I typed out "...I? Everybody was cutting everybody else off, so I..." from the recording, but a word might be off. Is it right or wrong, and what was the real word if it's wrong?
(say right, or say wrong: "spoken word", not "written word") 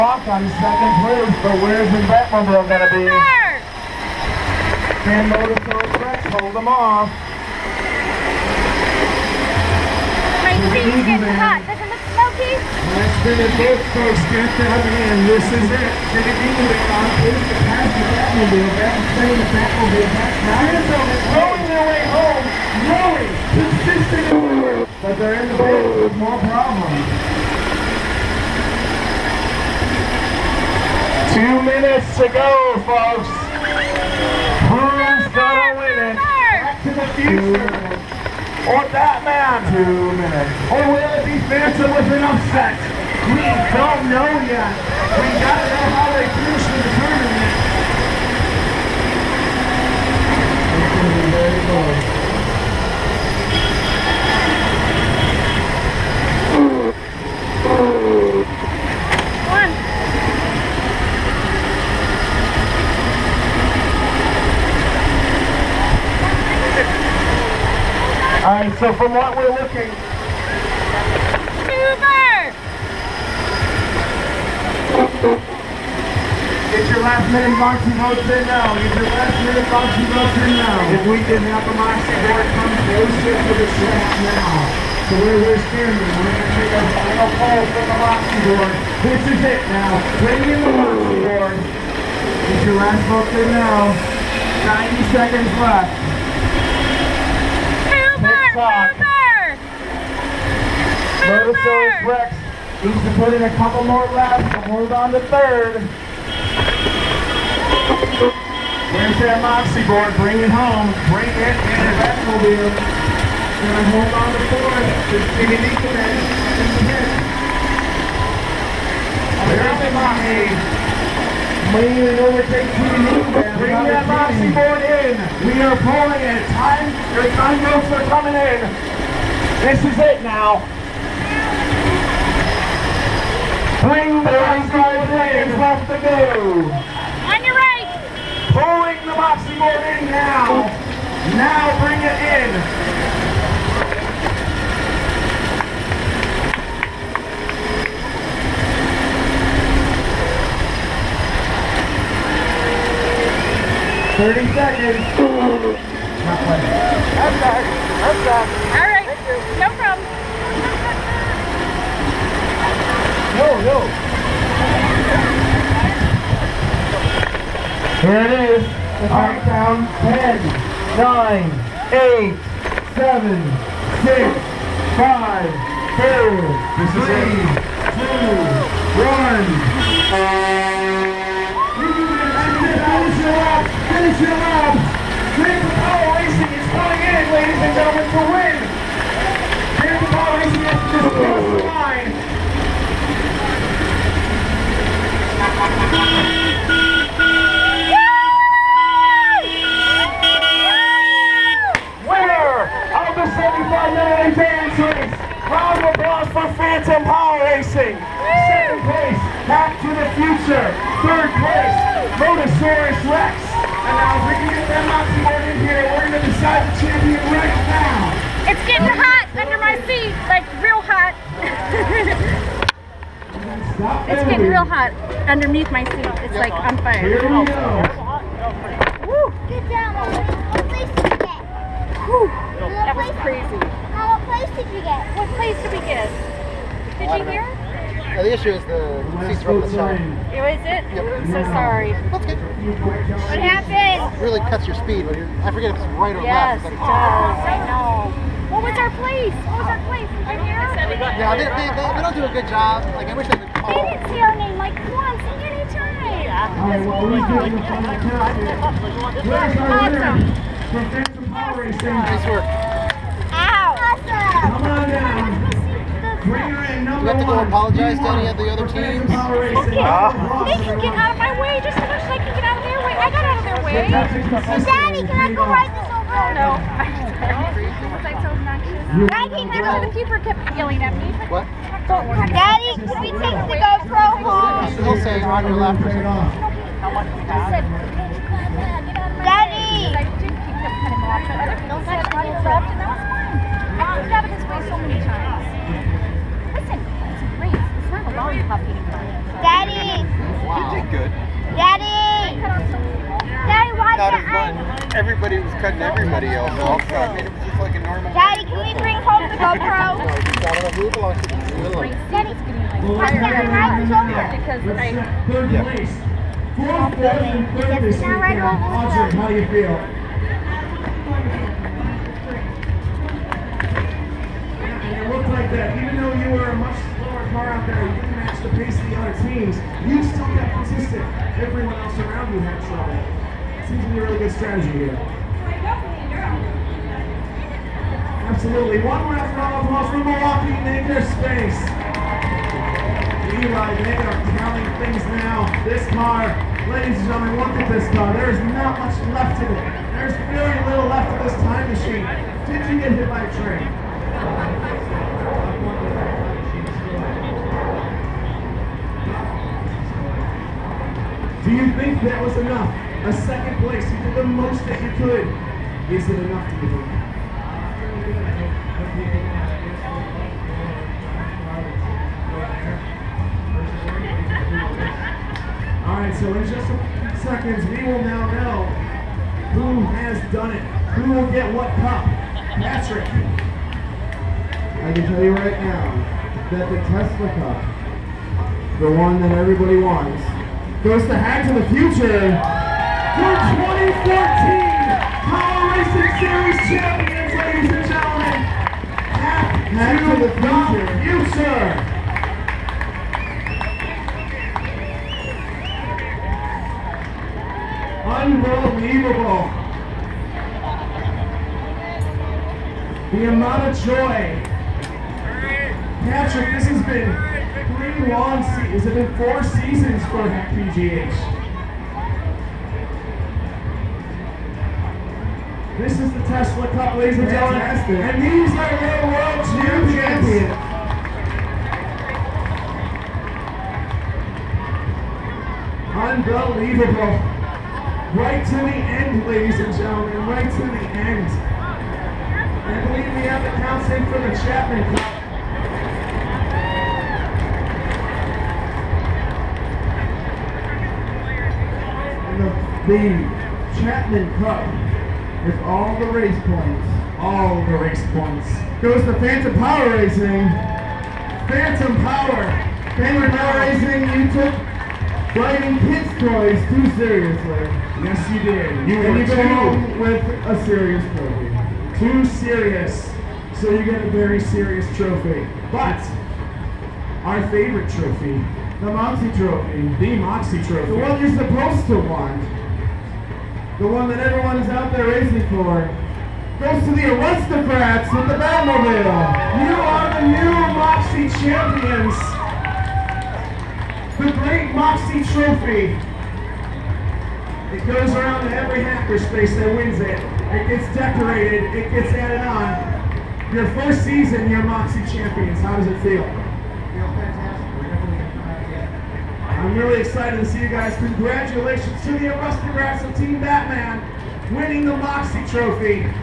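right.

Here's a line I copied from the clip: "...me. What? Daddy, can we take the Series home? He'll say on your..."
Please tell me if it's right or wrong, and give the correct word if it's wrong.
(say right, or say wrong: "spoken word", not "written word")
wrong: "GoPro", not "Series".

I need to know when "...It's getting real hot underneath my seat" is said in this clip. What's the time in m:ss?
3:43.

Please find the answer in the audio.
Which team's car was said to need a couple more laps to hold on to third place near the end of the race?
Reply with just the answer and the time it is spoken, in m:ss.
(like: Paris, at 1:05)
Motosaurus Rex, at 1:41.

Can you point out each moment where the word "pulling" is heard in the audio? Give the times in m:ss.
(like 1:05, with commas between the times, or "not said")
2:05, 2:18.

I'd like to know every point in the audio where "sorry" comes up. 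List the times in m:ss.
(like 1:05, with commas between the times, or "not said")
4:01, 4:36.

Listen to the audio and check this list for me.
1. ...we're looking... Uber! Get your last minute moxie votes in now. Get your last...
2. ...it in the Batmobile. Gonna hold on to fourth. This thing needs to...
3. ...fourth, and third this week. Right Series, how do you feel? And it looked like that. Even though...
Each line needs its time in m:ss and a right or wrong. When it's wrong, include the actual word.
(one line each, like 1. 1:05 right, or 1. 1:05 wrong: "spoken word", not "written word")
1. 1:09 right
2. 1:51 right
3. 5:16 wrong: "Audrey", not "Series".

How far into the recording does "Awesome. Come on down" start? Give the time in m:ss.
4:23.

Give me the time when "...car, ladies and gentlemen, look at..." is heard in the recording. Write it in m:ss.
5:45.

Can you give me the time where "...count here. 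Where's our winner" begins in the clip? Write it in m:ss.
4:17.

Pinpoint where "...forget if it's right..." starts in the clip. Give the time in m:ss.
4:05.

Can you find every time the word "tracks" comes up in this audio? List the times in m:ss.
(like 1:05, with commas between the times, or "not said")
0:05, 1:23.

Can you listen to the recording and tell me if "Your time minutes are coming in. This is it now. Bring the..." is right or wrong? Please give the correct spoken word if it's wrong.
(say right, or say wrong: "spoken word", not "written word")
wrong: "notes", not "minutes".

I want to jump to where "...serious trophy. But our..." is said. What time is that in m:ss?
7:54.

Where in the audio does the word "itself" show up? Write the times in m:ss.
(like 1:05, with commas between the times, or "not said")
not said.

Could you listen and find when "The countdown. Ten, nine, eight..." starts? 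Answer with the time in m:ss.
2:49.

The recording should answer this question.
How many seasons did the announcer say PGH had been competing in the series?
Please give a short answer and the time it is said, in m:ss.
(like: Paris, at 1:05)
4, at 6:59.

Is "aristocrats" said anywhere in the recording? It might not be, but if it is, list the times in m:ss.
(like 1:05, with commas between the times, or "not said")
8:07, 8:32.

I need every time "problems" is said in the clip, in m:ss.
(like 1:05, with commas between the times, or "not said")
0:26, 2:39.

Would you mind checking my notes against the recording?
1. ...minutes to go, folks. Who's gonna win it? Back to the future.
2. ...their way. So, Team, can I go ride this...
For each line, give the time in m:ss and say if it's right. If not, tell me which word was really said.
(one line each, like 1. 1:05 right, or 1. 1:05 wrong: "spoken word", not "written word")
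1. 0:31 right
2. 4:33 wrong: "Daddy", not "Team".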